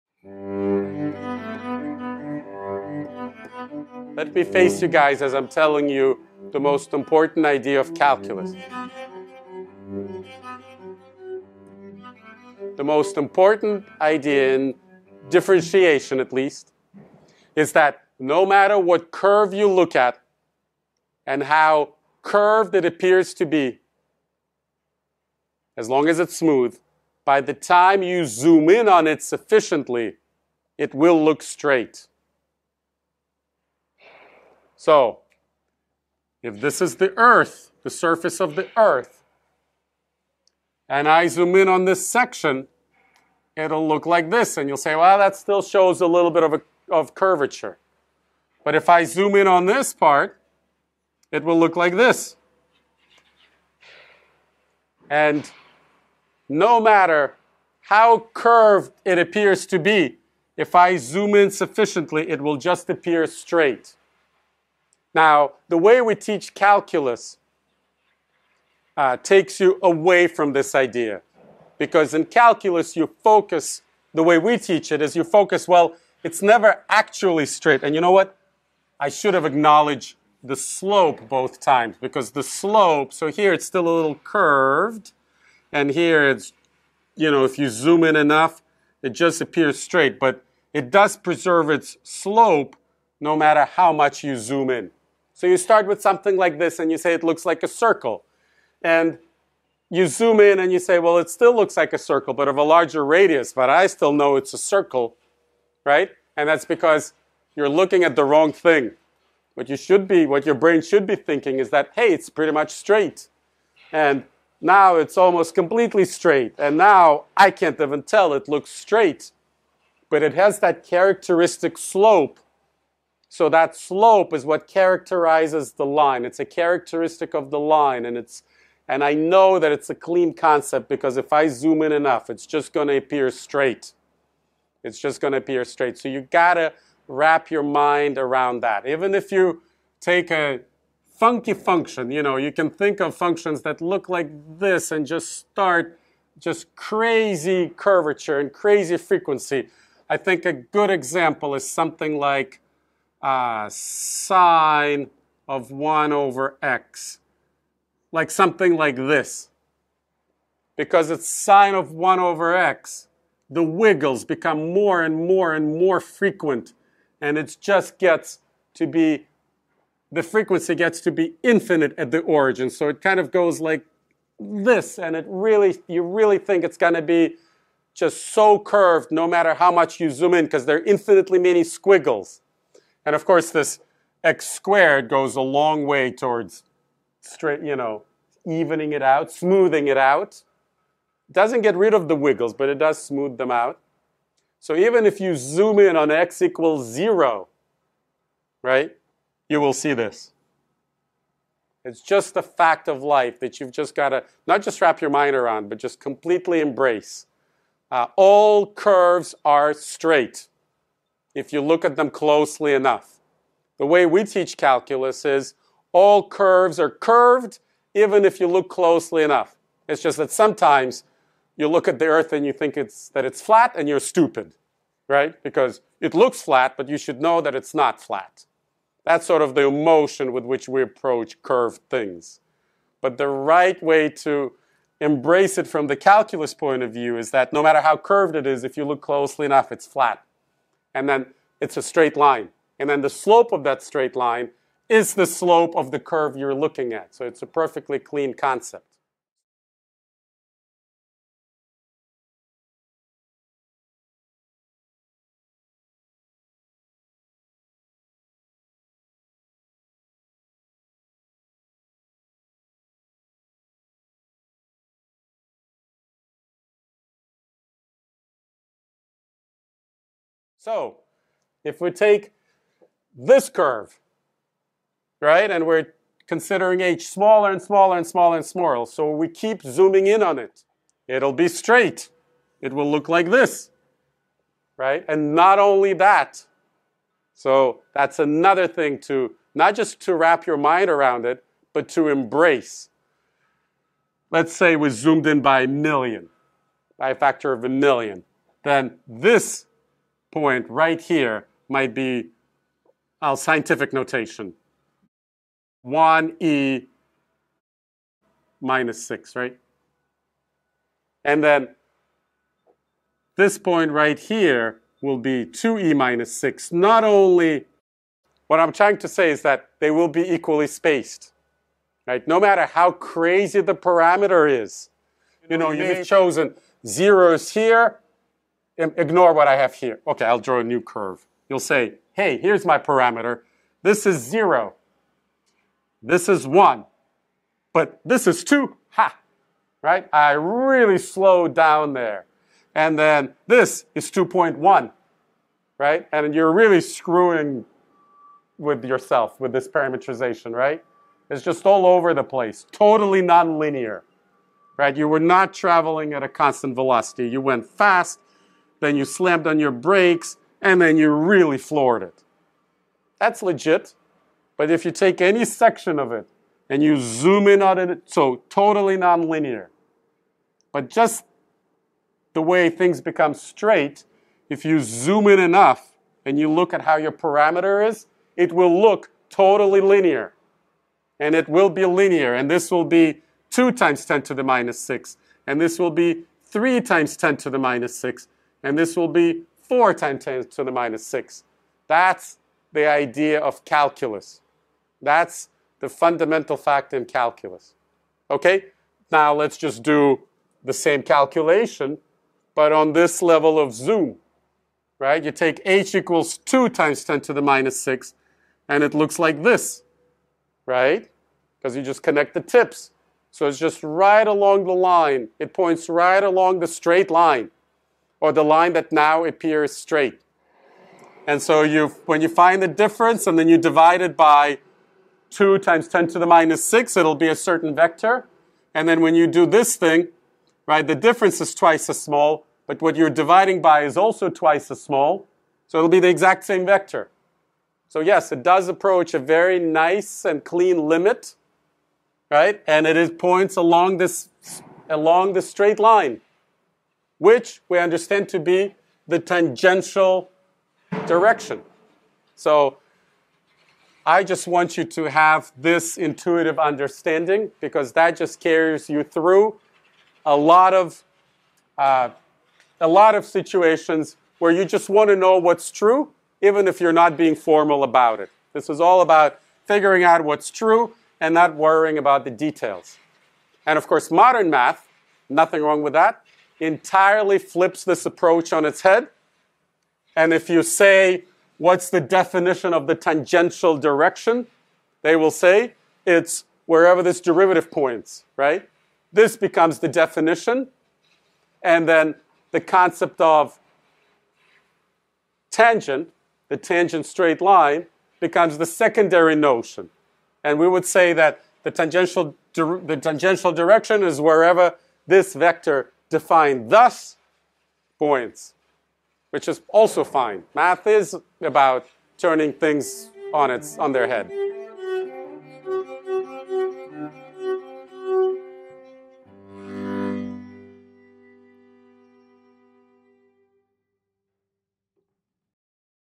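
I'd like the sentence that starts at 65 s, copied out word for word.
Now, the way we teach calculus uh, takes you away from this idea.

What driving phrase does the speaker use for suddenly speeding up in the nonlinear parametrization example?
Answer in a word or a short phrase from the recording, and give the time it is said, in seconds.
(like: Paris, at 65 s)
floored it, at 361 s.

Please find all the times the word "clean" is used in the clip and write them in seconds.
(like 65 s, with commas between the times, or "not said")
129 s, 247 s, 440 s.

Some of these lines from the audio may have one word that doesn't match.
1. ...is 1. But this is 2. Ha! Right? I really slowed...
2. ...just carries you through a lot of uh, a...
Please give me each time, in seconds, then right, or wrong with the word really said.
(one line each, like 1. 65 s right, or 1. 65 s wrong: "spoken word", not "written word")
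1. 336 s right
2. 458 s right.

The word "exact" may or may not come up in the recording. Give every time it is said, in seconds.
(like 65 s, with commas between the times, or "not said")
436 s.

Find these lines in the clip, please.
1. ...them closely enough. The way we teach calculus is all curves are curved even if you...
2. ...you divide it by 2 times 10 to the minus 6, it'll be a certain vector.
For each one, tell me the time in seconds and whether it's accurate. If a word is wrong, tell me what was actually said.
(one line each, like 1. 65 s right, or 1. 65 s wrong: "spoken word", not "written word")
1. 211 s right
2. 423 s right.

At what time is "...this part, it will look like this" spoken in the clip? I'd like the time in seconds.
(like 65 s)
49 s.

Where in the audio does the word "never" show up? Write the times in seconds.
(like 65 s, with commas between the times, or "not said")
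76 s.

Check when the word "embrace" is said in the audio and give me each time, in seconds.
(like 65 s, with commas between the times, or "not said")
206 s, 235 s, 292 s.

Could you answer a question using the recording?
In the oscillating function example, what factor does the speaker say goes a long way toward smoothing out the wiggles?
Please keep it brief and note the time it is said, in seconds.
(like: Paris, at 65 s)
x squared, at 184 s.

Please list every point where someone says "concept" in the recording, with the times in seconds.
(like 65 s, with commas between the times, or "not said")
130 s, 248 s, 492 s.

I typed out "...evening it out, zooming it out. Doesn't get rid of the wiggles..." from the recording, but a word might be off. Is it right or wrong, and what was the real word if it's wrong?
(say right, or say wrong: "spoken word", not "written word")
wrong: "smoothing", not "zooming".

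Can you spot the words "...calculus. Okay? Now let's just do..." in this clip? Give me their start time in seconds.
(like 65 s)
397 s.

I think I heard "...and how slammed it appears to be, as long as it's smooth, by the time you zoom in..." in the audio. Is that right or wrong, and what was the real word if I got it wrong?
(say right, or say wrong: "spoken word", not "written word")
wrong: "curved", not "slammed".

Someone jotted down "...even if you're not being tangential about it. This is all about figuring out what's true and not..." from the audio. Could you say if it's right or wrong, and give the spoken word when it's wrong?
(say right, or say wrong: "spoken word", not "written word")
wrong: "formal", not "tangential".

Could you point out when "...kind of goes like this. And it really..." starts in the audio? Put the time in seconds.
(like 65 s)
173 s.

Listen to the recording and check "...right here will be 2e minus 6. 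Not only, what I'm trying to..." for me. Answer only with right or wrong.
right.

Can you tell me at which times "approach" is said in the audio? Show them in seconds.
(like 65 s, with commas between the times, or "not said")
230 s, 438 s, 478 s.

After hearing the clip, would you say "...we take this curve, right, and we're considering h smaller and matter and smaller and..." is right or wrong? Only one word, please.
wrong.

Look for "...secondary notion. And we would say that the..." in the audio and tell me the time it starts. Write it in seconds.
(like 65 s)
498 s.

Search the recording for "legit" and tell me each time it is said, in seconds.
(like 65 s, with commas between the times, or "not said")
363 s.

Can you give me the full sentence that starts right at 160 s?
Because it's sine of 1 over x, the wiggles become more and more and more frequent.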